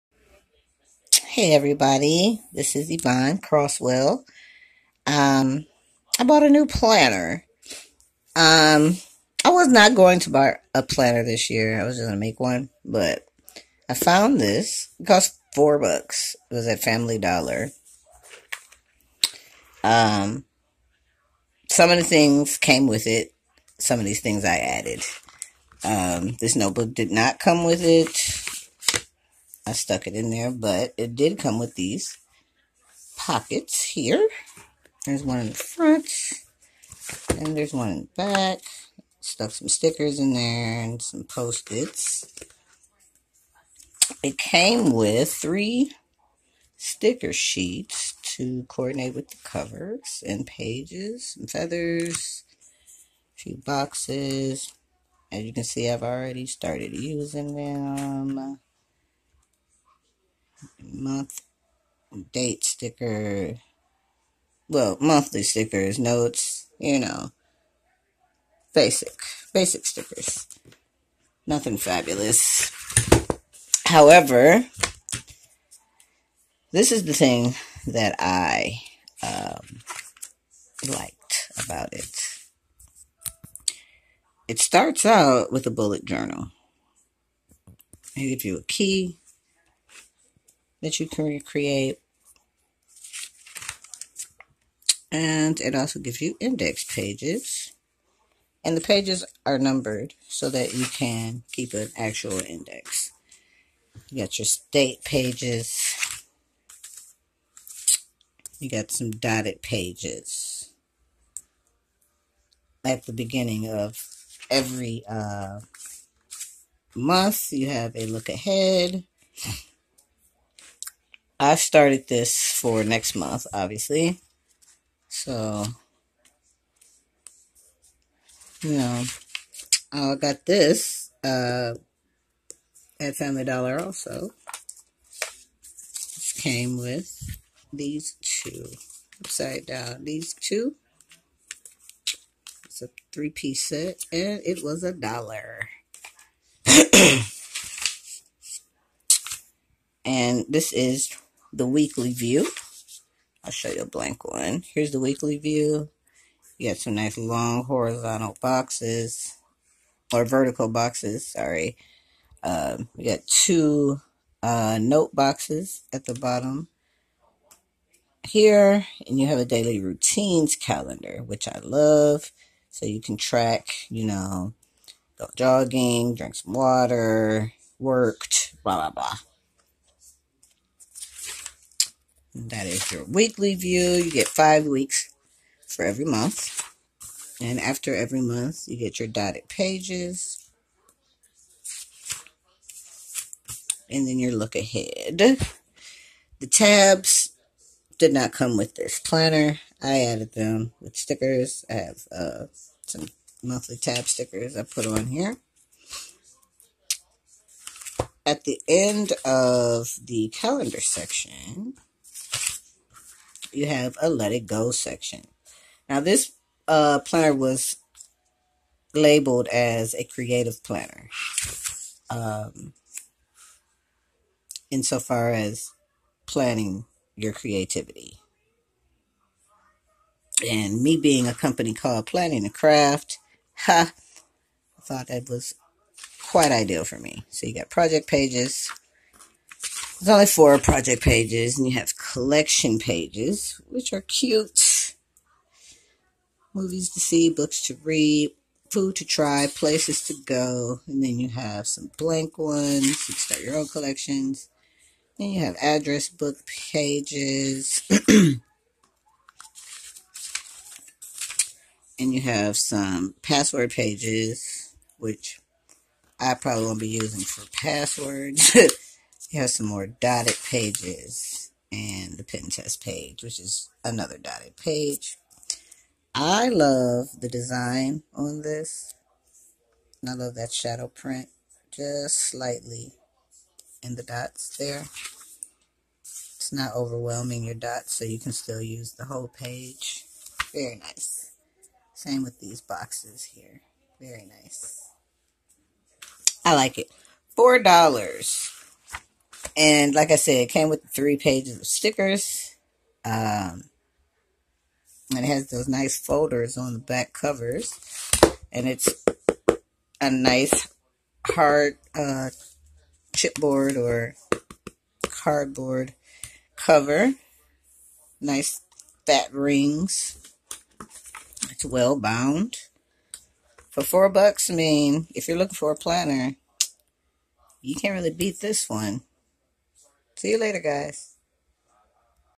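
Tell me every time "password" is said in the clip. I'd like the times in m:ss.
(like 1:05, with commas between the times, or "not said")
4:23, 4:27.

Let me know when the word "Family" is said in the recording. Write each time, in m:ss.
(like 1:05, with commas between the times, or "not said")
0:16, 2:13.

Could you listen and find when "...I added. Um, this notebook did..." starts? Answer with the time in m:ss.
0:24.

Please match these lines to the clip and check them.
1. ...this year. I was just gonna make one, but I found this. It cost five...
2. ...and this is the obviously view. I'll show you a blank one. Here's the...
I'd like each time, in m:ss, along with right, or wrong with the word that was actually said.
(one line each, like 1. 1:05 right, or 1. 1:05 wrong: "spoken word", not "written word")
1. 0:11 wrong: "four", not "five"
2. 2:30 wrong: "weekly", not "obviously".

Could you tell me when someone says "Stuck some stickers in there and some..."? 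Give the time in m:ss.
0:39.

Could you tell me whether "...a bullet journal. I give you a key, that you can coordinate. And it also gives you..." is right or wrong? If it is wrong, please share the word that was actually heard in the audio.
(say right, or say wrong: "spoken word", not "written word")
wrong: "recreate", not "coordinate".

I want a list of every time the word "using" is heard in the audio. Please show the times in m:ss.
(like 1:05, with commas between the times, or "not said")
0:56, 4:26.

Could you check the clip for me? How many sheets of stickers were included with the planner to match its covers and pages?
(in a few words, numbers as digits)
3.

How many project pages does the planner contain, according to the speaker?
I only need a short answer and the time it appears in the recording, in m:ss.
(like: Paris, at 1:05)
4, at 4:00.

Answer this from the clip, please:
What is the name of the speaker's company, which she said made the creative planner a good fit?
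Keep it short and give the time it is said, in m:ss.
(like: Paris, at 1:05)
Planning a Craft, at 3:52.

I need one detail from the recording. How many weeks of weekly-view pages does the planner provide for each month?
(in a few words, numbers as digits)
5.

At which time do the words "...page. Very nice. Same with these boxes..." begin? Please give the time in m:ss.
4:49.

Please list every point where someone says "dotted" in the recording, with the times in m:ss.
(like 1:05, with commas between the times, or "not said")
1:49, 3:09, 4:29, 4:34.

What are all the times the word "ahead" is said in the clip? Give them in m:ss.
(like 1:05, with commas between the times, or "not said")
1:58, 3:14.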